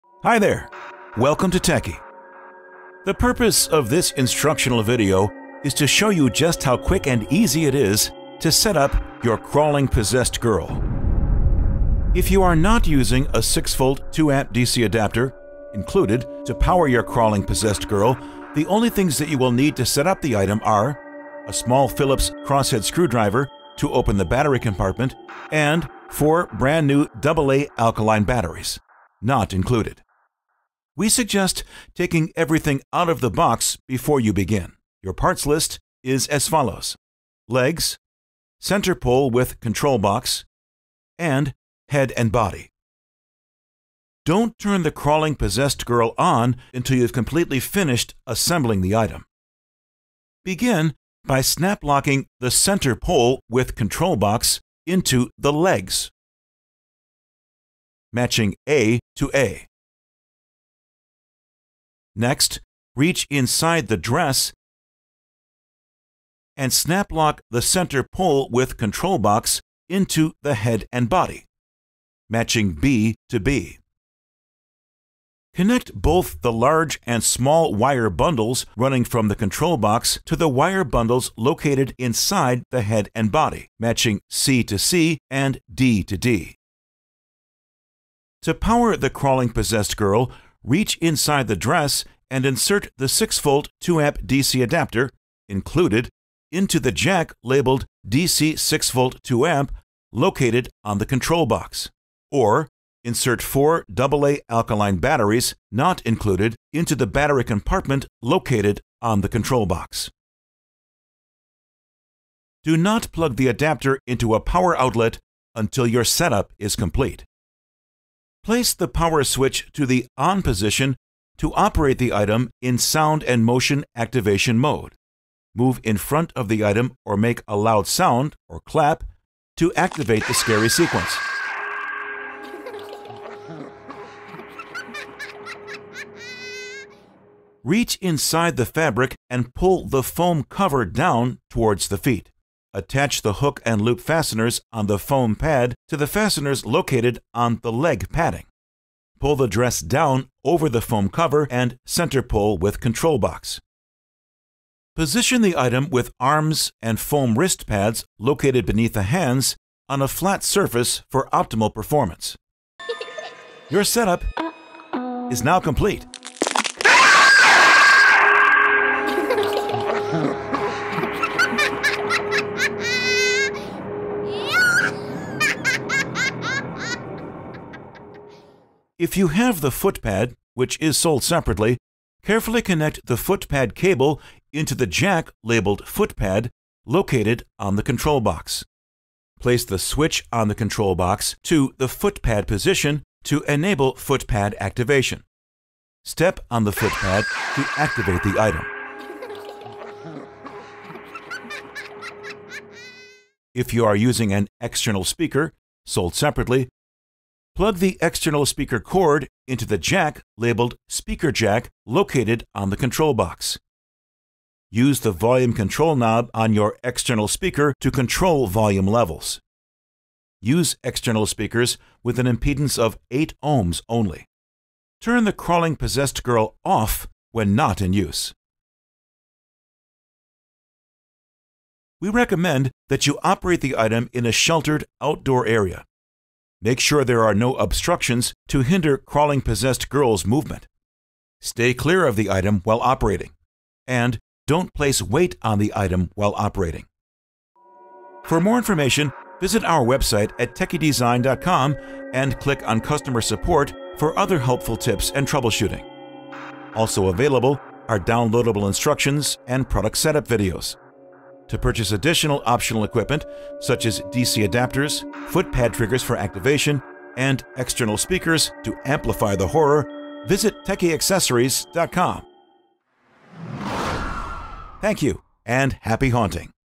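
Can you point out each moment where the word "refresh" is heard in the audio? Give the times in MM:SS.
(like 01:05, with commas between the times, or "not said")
not said.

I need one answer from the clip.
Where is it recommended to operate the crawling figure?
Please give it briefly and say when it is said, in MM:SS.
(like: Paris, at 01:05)
Sheltered outdoor area, at 03:54.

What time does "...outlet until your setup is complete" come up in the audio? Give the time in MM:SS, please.
01:54.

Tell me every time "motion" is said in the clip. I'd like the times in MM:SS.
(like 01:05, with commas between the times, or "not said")
02:03.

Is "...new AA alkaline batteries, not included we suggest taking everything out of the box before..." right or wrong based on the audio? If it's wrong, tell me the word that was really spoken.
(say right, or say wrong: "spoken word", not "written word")
right.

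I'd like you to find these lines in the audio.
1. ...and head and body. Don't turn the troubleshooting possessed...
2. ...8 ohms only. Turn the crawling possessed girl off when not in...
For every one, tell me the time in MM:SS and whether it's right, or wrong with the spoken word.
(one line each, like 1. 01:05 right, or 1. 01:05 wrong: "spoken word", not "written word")
1. 00:41 wrong: "crawling", not "troubleshooting"
2. 03:43 right.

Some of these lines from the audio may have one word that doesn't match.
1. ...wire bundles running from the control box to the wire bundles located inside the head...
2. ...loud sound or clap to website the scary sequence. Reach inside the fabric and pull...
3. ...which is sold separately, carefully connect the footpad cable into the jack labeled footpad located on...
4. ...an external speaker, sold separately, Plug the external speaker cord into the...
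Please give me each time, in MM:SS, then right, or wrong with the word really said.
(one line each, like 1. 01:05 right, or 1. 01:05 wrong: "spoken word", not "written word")
1. 01:17 right
2. 02:07 wrong: "activate", not "website"
3. 03:00 right
4. 03:24 right.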